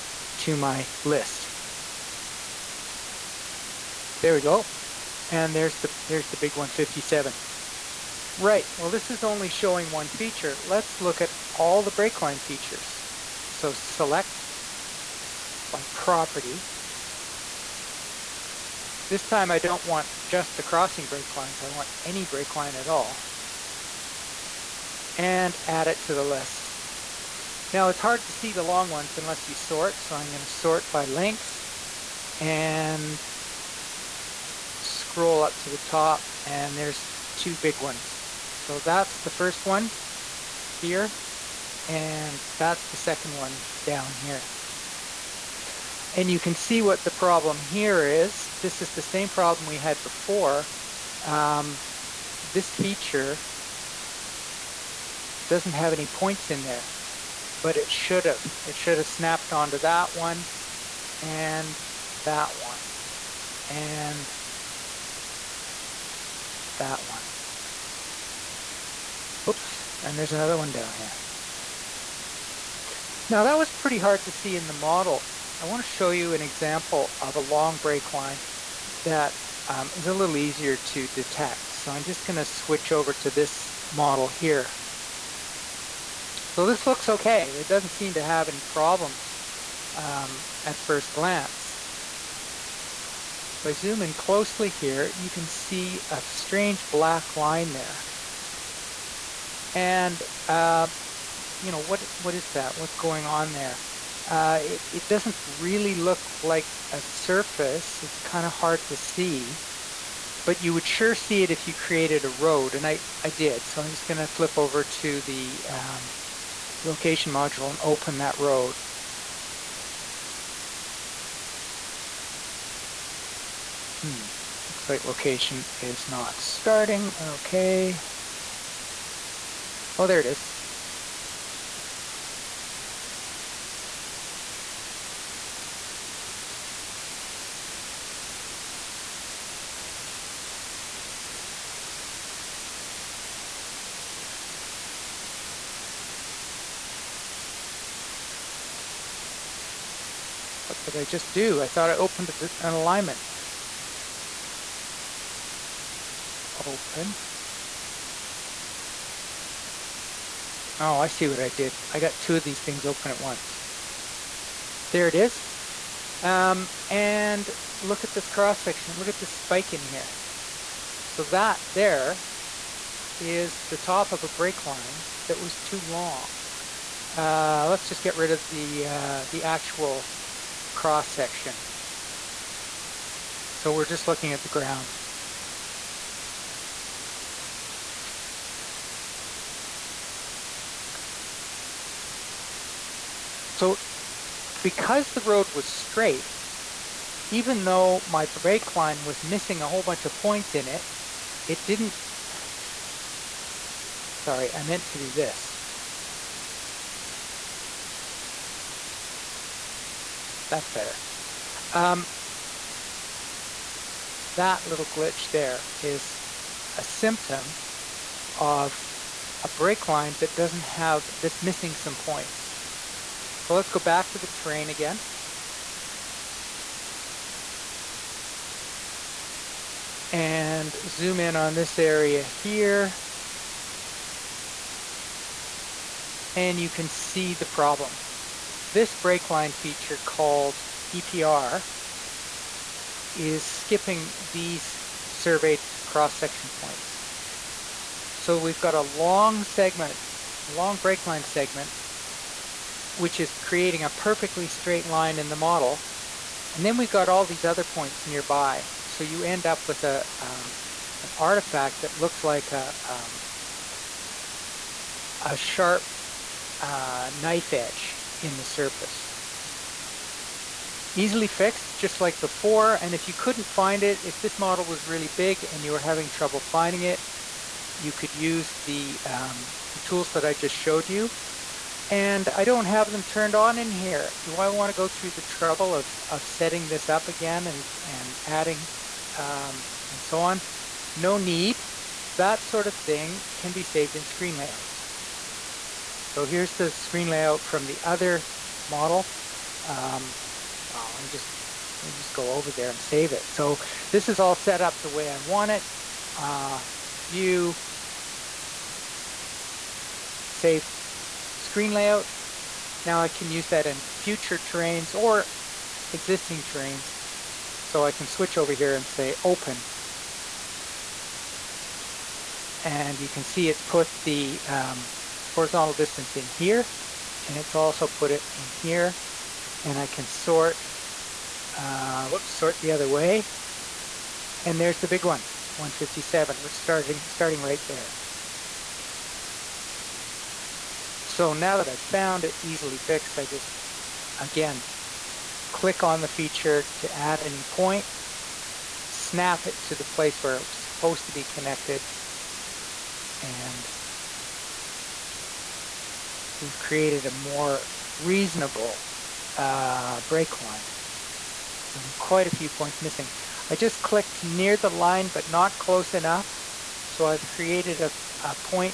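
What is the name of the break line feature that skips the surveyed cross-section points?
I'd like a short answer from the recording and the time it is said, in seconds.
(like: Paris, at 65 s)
EPR, at 240 s.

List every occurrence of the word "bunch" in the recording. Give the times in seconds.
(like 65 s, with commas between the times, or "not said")
199 s.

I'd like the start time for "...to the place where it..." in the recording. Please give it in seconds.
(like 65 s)
349 s.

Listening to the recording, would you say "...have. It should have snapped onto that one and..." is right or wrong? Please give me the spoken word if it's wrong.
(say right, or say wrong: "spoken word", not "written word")
right.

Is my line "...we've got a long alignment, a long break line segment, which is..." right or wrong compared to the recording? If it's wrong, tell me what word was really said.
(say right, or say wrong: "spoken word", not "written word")
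wrong: "segment", not "alignment".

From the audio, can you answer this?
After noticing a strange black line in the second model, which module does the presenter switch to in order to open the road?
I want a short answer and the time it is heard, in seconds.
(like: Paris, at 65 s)
Location module, at 116 s.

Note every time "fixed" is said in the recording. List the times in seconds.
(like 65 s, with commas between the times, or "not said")
271 s, 342 s.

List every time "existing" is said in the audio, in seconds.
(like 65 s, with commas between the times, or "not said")
315 s.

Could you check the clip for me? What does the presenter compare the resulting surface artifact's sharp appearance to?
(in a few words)
Knife edge.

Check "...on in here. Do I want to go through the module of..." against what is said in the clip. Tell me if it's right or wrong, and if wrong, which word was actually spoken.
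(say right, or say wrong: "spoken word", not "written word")
wrong: "trouble", not "module".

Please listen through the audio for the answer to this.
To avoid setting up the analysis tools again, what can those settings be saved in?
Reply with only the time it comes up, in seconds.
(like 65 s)
294 s.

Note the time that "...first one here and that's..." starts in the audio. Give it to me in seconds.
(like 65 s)
39 s.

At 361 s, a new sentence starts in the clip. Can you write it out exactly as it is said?
There were quite a few points missing.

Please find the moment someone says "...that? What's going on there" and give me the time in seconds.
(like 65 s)
102 s.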